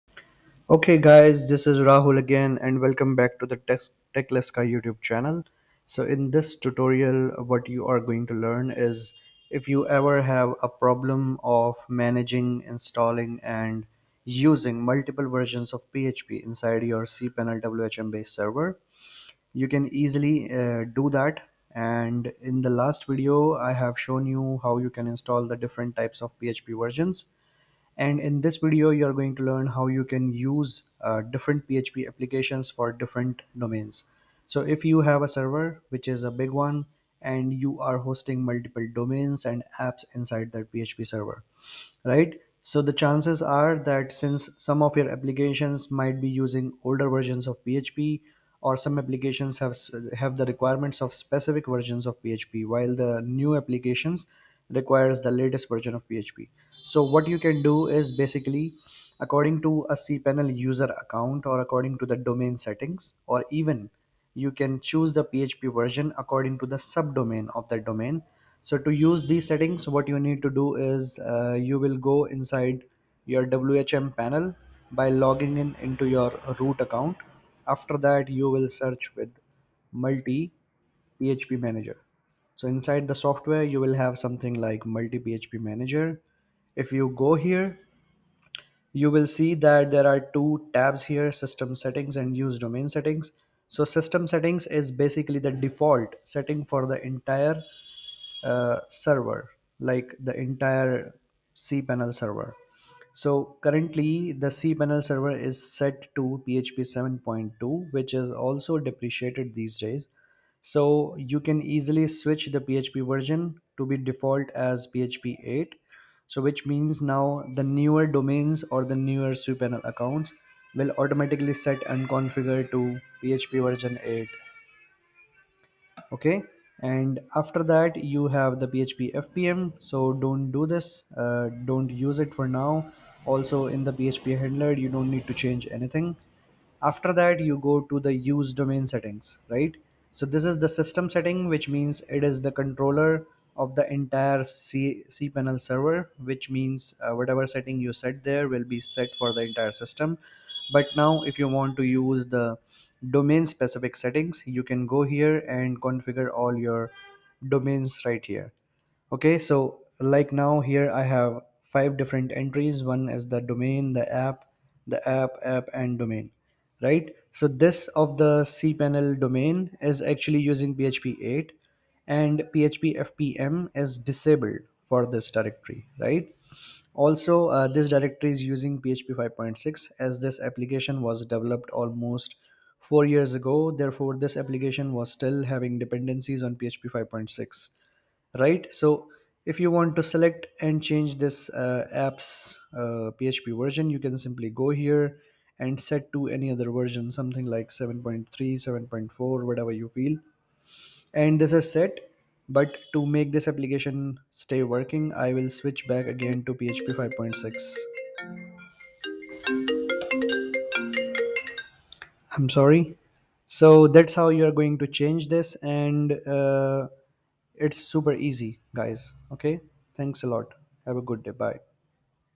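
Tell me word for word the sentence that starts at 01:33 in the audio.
So system settings is basically the default setting for the entire uh, server, like the entire cPanel server.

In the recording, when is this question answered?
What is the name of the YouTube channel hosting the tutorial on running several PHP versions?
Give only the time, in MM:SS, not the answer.
00:03.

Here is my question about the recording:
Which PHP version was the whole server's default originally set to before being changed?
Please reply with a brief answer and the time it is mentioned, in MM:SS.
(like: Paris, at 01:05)
PHP 7.2, at 01:46.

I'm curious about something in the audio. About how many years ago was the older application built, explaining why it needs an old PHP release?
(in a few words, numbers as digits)
4.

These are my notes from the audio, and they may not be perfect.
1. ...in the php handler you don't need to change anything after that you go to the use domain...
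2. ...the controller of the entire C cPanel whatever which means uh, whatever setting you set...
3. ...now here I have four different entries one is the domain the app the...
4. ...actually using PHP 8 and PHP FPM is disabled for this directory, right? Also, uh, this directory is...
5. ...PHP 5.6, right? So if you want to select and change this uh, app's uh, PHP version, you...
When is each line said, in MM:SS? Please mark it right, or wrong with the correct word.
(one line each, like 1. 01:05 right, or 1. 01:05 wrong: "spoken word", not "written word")
1. 02:13 right
2. 02:22 wrong: "server", not "whatever"
3. 02:40 wrong: "five", not "four"
4. 02:50 right
5. 03:06 right.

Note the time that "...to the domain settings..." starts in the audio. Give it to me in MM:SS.
01:01.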